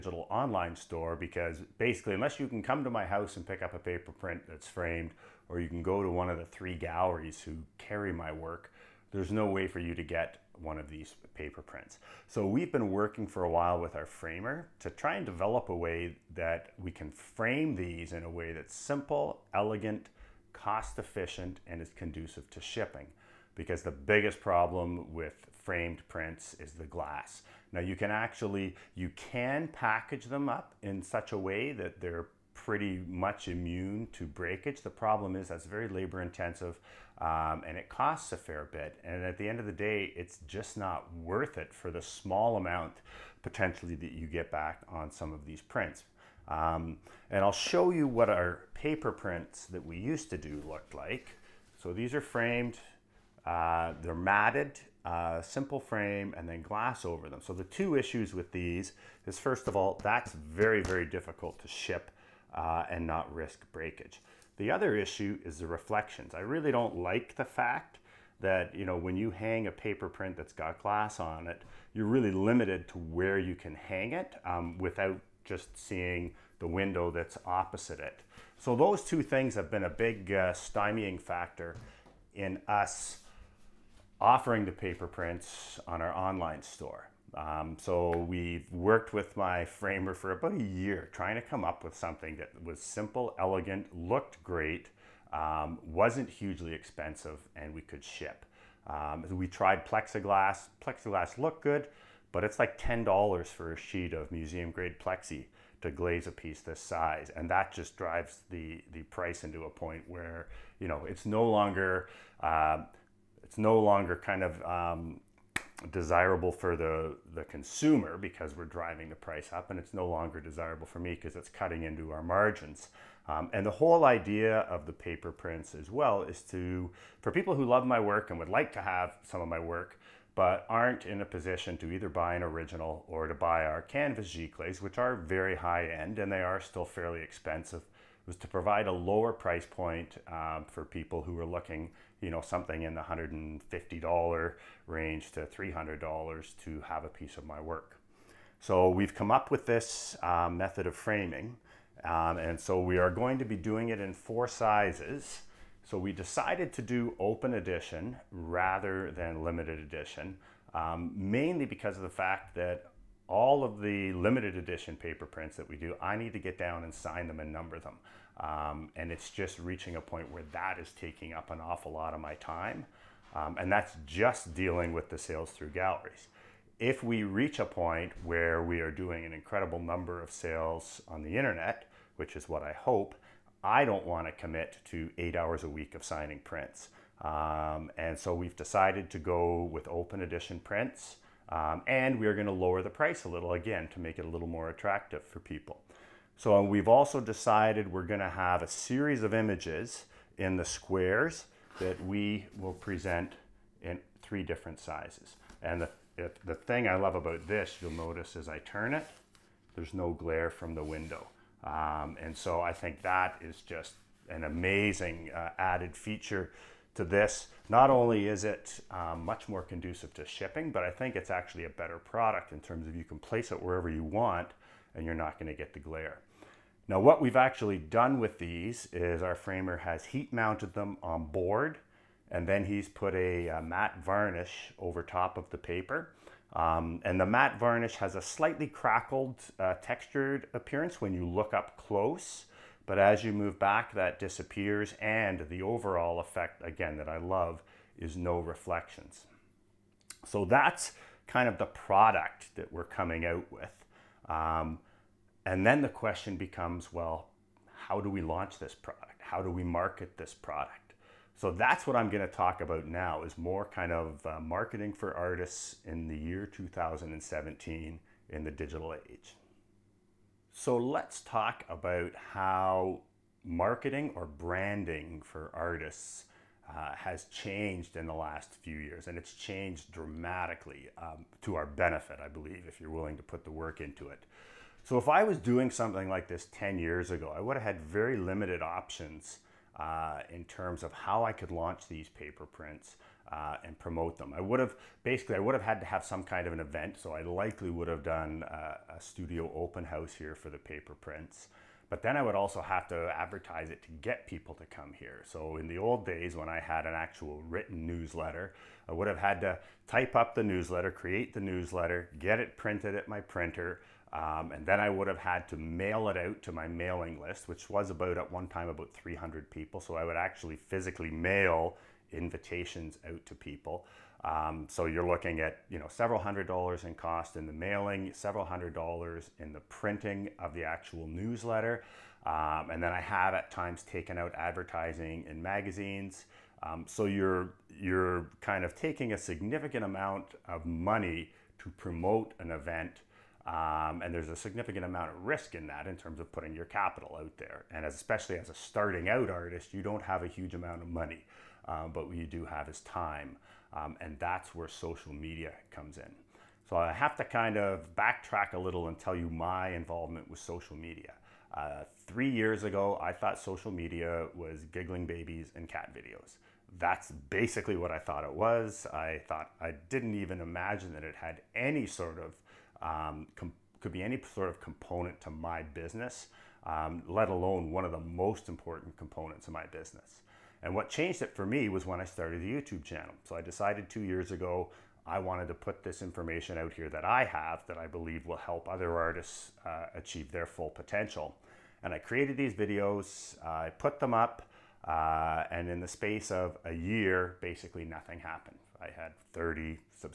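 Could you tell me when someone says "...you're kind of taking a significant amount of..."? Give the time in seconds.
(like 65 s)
337 s.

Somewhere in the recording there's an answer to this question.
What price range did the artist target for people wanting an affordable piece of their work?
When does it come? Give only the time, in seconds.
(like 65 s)
143 s.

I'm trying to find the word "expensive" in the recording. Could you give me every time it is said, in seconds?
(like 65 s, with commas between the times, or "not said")
96 s, 137 s.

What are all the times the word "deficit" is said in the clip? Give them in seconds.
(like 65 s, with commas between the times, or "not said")
not said.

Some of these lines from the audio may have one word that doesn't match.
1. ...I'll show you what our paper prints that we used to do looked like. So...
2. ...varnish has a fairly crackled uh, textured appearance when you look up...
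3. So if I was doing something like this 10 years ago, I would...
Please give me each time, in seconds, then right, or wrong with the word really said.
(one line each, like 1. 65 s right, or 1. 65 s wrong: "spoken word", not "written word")
1. 47 s right
2. 237 s wrong: "slightly", not "fairly"
3. 284 s right.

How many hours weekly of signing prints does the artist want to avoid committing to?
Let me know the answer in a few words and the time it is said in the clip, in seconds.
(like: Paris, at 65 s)
8, at 185 s.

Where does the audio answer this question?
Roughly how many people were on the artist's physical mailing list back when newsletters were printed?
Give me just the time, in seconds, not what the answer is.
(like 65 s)
318 s.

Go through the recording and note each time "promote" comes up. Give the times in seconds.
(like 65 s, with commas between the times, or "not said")
293 s, 341 s.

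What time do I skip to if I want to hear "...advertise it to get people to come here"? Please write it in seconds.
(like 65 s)
303 s.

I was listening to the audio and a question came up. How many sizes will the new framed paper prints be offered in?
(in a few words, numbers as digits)
4.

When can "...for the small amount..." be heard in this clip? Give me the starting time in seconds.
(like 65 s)
41 s.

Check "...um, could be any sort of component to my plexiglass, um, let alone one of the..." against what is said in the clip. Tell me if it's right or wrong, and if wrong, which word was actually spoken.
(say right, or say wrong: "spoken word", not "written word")
wrong: "business", not "plexiglass".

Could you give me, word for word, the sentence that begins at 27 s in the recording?
Now you can actually, you can package them up in such a way that they're pretty much immune to breakage.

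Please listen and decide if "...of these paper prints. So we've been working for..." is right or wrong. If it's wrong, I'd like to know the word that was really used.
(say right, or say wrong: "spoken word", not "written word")
right.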